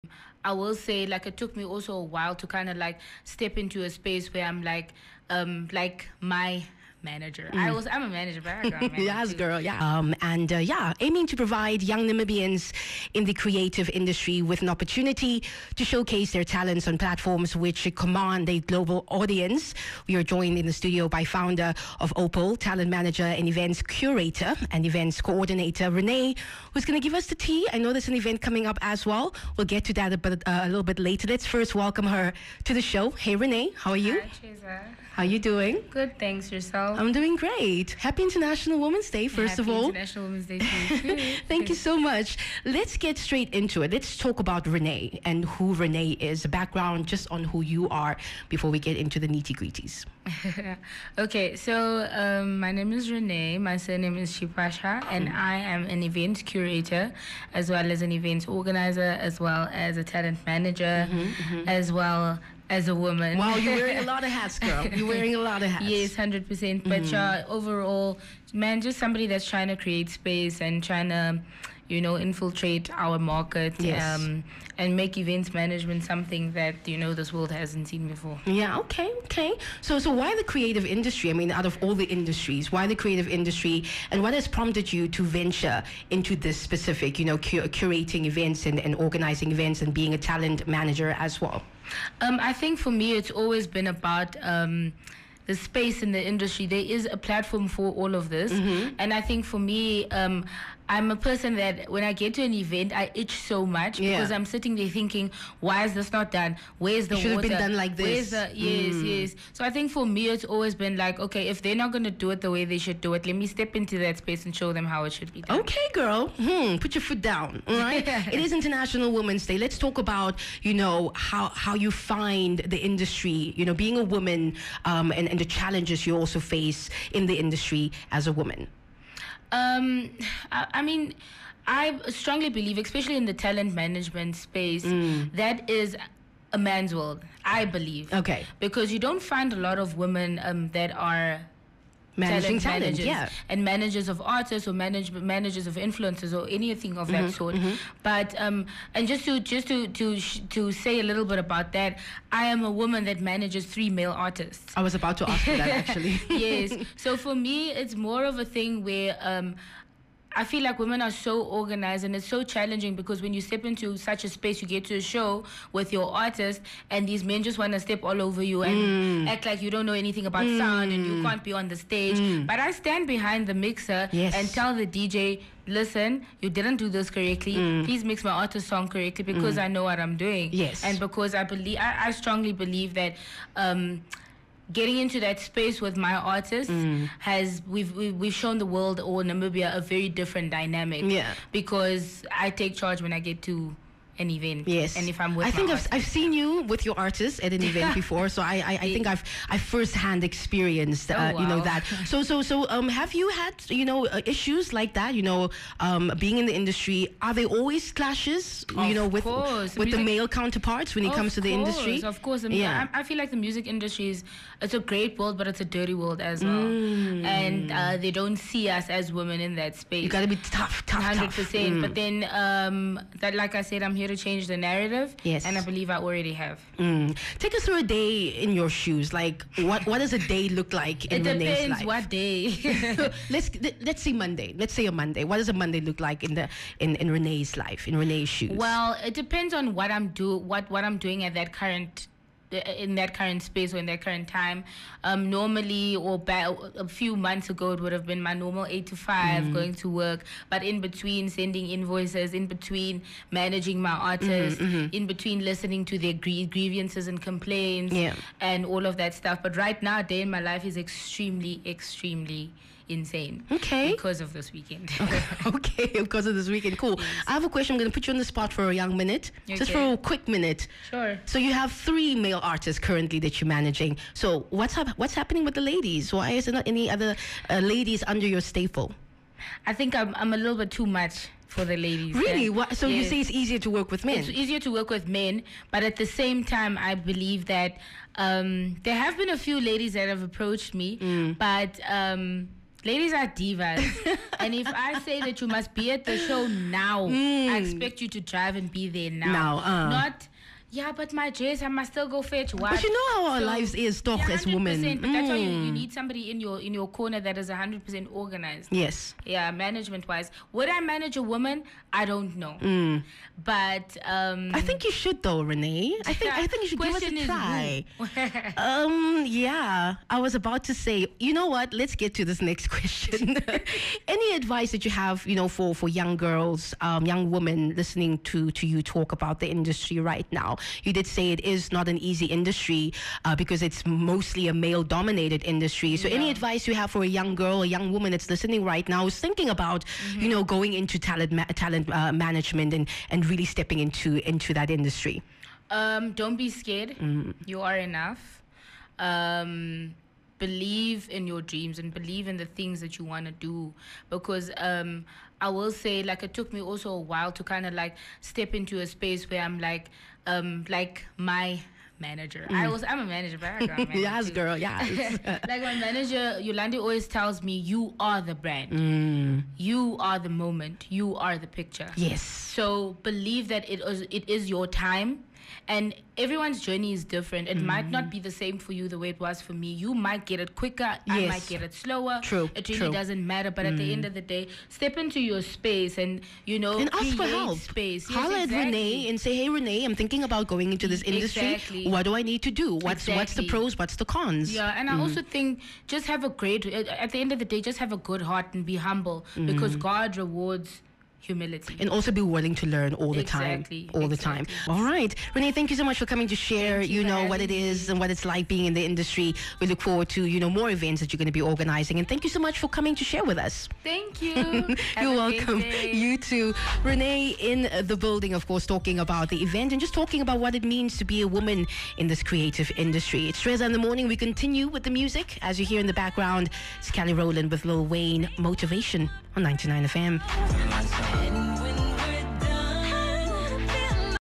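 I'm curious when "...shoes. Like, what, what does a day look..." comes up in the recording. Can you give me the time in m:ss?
3:48.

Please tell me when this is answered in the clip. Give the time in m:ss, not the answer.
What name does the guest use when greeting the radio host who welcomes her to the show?
0:34.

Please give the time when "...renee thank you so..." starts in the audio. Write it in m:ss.
6:45.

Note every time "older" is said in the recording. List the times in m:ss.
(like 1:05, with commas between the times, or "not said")
not said.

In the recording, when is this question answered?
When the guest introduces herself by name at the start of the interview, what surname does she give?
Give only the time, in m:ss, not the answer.
0:54.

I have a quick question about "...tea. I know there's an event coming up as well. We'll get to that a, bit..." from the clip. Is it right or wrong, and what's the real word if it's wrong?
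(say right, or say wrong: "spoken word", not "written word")
right.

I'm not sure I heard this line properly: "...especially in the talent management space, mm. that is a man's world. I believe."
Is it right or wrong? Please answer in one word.
right.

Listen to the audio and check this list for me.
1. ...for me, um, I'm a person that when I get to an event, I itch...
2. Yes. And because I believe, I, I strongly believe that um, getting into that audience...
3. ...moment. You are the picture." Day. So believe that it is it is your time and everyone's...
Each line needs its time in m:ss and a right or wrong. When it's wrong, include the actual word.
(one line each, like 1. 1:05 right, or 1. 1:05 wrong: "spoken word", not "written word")
1. 1:39 right
2. 3:00 wrong: "space", not "audience"
3. 6:10 wrong: "Yes", not "Day".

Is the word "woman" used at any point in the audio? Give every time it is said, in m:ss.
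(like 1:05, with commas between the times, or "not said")
1:02, 2:04, 2:08, 2:32, 5:11, 5:37, 7:01.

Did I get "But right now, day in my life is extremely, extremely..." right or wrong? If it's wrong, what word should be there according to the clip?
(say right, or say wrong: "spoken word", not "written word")
right.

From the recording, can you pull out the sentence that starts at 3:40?
You gotta be tough, tough, 100%.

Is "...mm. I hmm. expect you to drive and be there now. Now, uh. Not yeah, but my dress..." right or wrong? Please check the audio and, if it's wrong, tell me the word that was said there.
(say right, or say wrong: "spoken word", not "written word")
right.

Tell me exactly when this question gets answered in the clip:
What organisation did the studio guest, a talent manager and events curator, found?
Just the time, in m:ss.
0:22.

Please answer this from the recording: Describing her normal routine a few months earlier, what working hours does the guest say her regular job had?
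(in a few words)
8 to 5.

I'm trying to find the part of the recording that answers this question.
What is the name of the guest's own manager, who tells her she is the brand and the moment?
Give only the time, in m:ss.
6:06.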